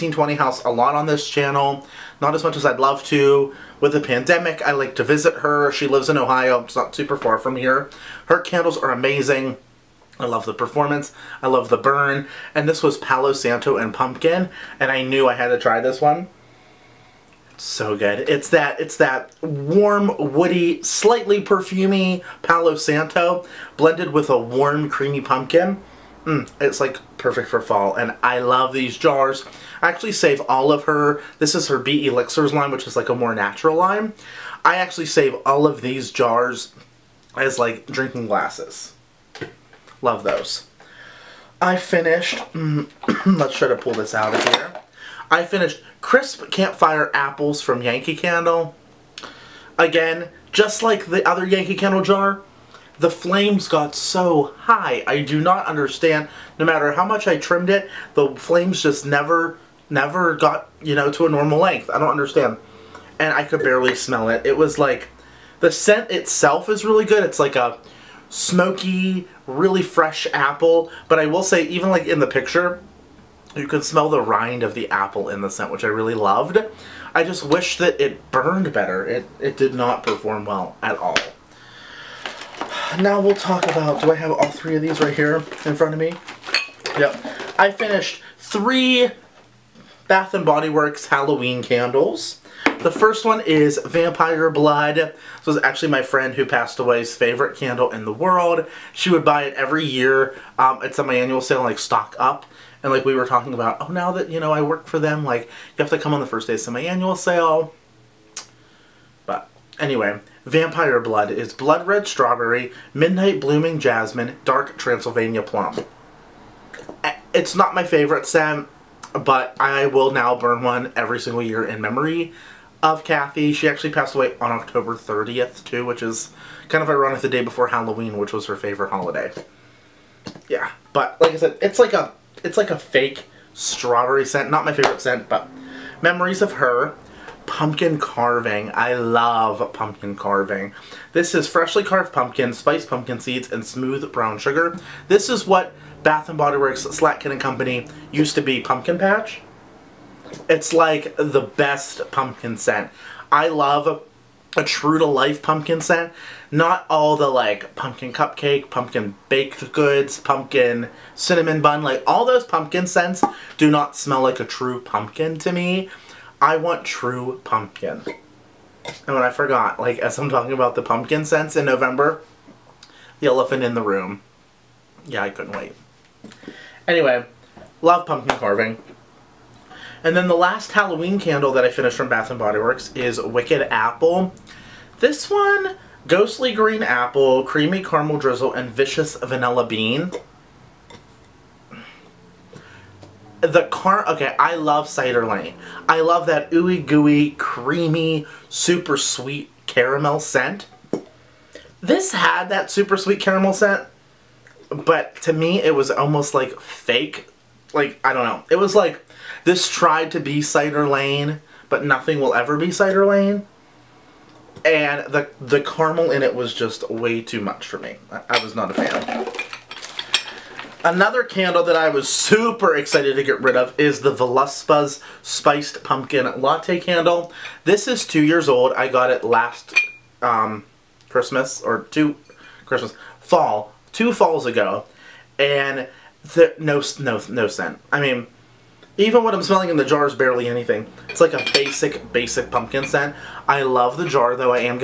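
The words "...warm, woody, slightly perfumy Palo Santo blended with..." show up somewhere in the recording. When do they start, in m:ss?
0:19.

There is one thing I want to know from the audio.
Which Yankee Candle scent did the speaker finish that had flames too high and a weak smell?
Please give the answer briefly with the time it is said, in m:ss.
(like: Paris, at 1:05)
Crisp Campfire Apples, at 0:46.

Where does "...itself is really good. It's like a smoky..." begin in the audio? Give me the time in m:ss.
1:06.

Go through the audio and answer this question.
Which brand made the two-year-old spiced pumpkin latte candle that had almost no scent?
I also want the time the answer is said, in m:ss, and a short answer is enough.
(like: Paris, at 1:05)
Veluspa, at 3:44.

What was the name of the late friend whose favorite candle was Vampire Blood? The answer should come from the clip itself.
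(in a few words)
Kathy.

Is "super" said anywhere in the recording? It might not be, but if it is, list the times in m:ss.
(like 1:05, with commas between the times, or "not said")
0:06, 3:18, 3:22, 3:42.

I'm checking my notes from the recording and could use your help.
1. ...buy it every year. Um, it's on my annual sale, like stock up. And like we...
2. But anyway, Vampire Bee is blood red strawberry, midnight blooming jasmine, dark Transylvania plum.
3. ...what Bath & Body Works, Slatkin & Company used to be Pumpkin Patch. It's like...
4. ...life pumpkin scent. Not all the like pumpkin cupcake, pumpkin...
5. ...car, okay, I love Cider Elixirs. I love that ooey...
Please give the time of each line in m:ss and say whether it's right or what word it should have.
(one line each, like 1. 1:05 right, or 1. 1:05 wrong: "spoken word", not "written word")
1. 1:39 right
2. 1:49 wrong: "Blood", not "Bee"
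3. 2:25 right
4. 2:35 right
5. 3:13 wrong: "Lane", not "Elixirs".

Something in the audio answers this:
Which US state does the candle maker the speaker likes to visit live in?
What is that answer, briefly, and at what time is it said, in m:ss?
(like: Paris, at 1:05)
Ohio, at 0:06.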